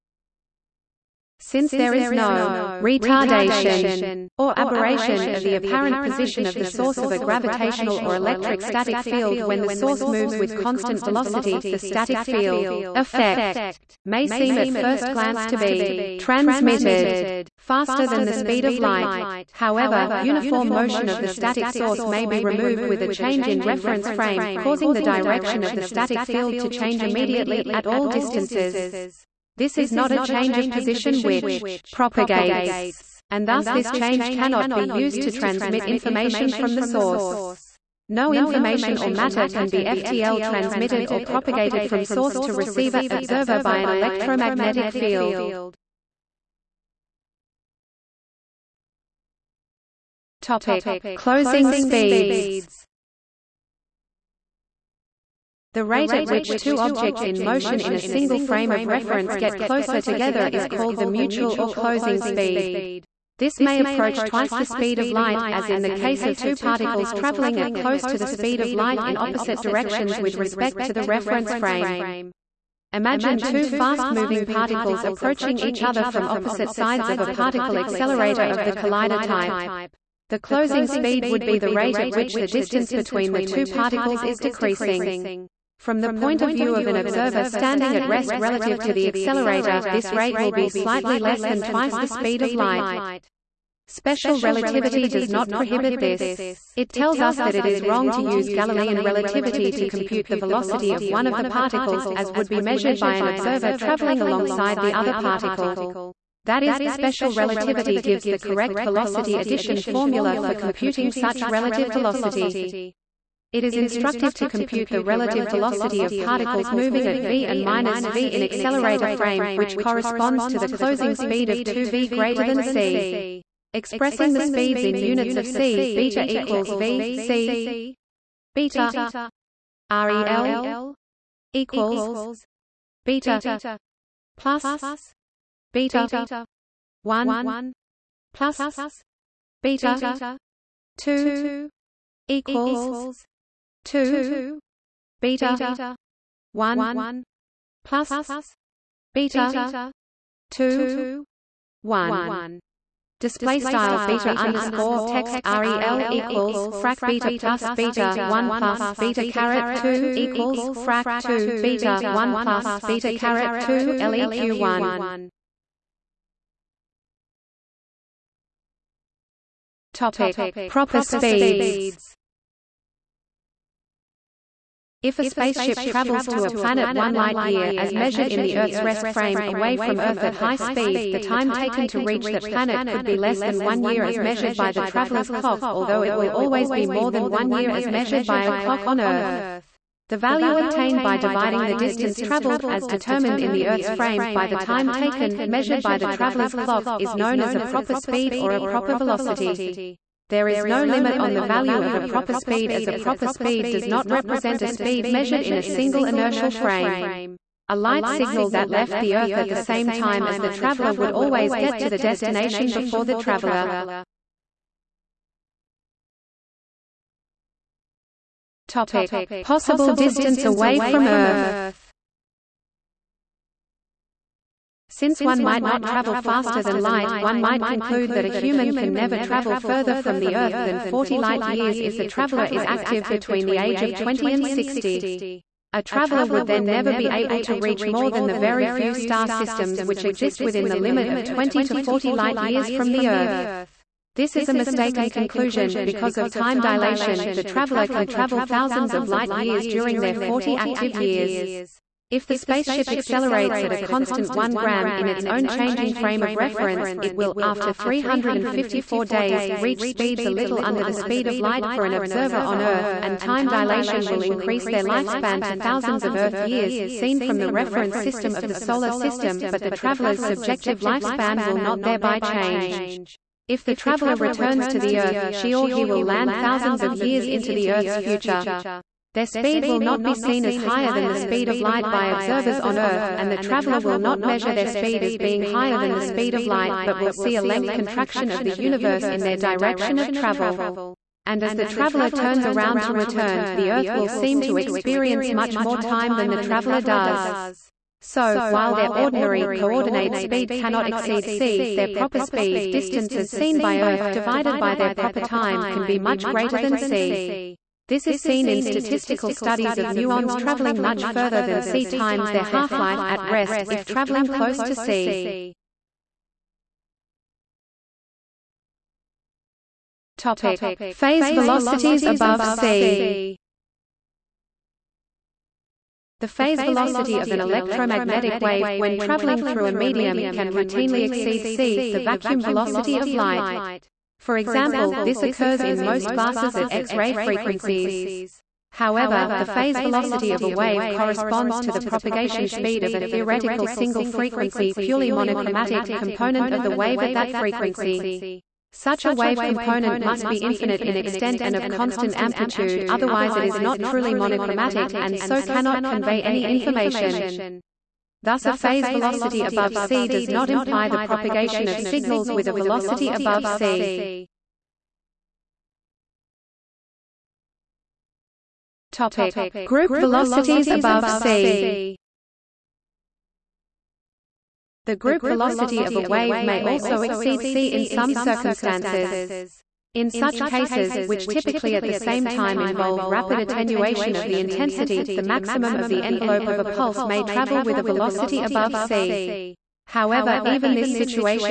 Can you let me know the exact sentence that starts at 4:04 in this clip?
This is a mistaken conclusion, because of time dilation, the traveler can travel thousands of light-years during their 40 active years.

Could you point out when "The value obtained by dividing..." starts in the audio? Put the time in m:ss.
3:10.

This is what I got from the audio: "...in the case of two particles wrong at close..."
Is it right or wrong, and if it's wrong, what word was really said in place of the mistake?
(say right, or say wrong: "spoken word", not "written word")
wrong: "traveling", not "wrong".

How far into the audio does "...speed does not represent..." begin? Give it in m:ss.
3:23.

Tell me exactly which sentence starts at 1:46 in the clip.
That is, special relativity gives the correct velocity addition formula for computing such relative velocity.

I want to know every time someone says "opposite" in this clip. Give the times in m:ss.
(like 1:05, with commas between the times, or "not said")
1:09, 1:16.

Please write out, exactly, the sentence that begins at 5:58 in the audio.
Thus a phase velocity above c does not imply the propagation of signals with a velocity above c.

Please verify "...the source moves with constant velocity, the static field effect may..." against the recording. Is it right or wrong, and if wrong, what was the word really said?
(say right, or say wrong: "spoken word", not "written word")
right.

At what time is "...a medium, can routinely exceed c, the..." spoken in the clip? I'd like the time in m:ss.
5:29.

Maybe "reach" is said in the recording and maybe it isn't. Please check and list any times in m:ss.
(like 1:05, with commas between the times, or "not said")
3:01, 3:57, 4:19.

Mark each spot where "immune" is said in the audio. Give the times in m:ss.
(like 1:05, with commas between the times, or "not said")
not said.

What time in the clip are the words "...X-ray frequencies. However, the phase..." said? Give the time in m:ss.
5:36.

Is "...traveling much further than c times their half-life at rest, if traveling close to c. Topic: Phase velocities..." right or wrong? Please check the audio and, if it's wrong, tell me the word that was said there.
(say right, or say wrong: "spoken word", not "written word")
right.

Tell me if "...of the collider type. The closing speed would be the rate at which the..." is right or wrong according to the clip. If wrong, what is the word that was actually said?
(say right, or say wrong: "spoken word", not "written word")
right.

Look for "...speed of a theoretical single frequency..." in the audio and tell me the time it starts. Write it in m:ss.
5:42.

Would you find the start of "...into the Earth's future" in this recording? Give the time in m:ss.
4:37.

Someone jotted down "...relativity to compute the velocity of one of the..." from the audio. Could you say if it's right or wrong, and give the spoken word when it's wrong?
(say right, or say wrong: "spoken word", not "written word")
right.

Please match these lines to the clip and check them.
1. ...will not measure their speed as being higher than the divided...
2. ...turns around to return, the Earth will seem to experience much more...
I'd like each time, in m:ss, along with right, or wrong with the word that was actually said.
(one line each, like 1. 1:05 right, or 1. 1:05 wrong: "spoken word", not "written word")
1. 4:43 wrong: "speed", not "divided"
2. 4:52 right.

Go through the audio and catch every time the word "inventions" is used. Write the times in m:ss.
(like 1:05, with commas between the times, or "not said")
not said.